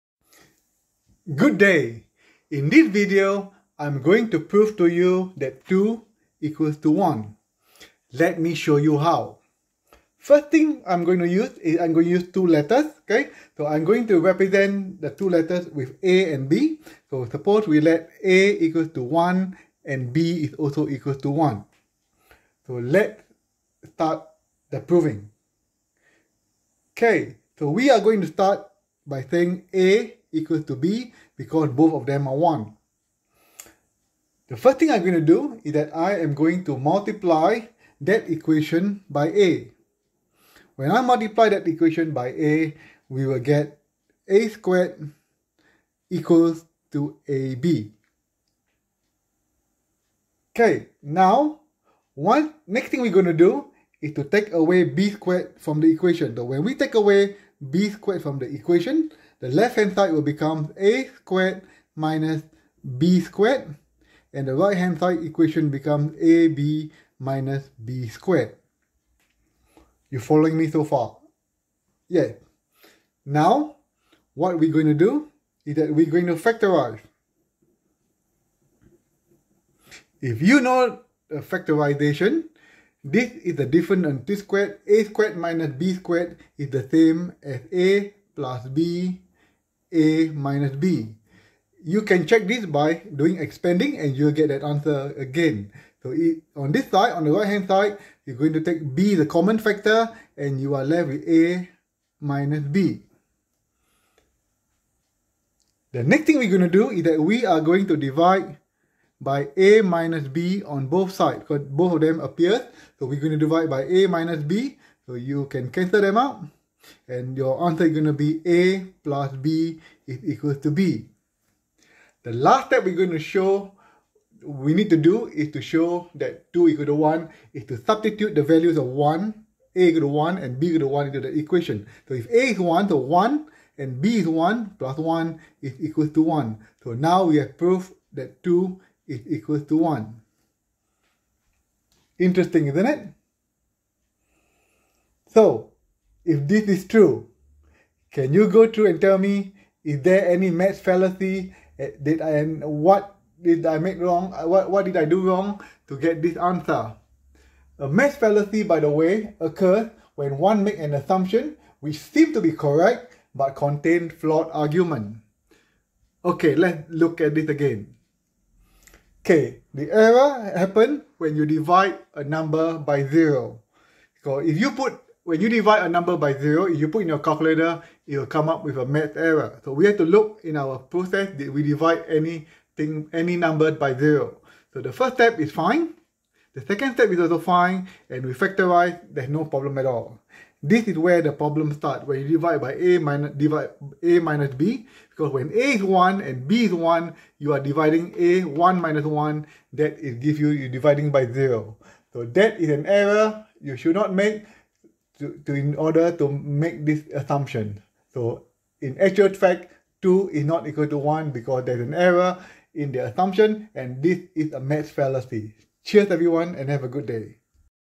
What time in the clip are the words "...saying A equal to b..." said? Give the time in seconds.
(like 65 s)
29 s.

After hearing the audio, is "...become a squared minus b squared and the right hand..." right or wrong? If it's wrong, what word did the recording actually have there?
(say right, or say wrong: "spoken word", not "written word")
right.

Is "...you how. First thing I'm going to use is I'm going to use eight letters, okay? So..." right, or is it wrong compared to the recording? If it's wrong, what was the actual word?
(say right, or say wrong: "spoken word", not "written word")
wrong: "two", not "eight".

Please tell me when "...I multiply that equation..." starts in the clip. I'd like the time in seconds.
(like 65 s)
40 s.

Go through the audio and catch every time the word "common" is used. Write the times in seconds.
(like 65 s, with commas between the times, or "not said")
99 s.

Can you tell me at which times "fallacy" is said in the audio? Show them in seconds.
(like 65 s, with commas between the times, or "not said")
150 s, 158 s, 214 s.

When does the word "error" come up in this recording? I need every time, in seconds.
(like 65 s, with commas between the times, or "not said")
169 s, 179 s, 202 s, 211 s.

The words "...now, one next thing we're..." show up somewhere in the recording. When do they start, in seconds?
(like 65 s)
51 s.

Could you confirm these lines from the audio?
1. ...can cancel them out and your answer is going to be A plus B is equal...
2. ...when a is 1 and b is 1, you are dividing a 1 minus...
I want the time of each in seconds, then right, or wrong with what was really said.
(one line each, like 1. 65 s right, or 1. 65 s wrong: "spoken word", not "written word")
1. 115 s right
2. 195 s right.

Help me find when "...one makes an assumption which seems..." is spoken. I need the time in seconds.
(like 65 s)
160 s.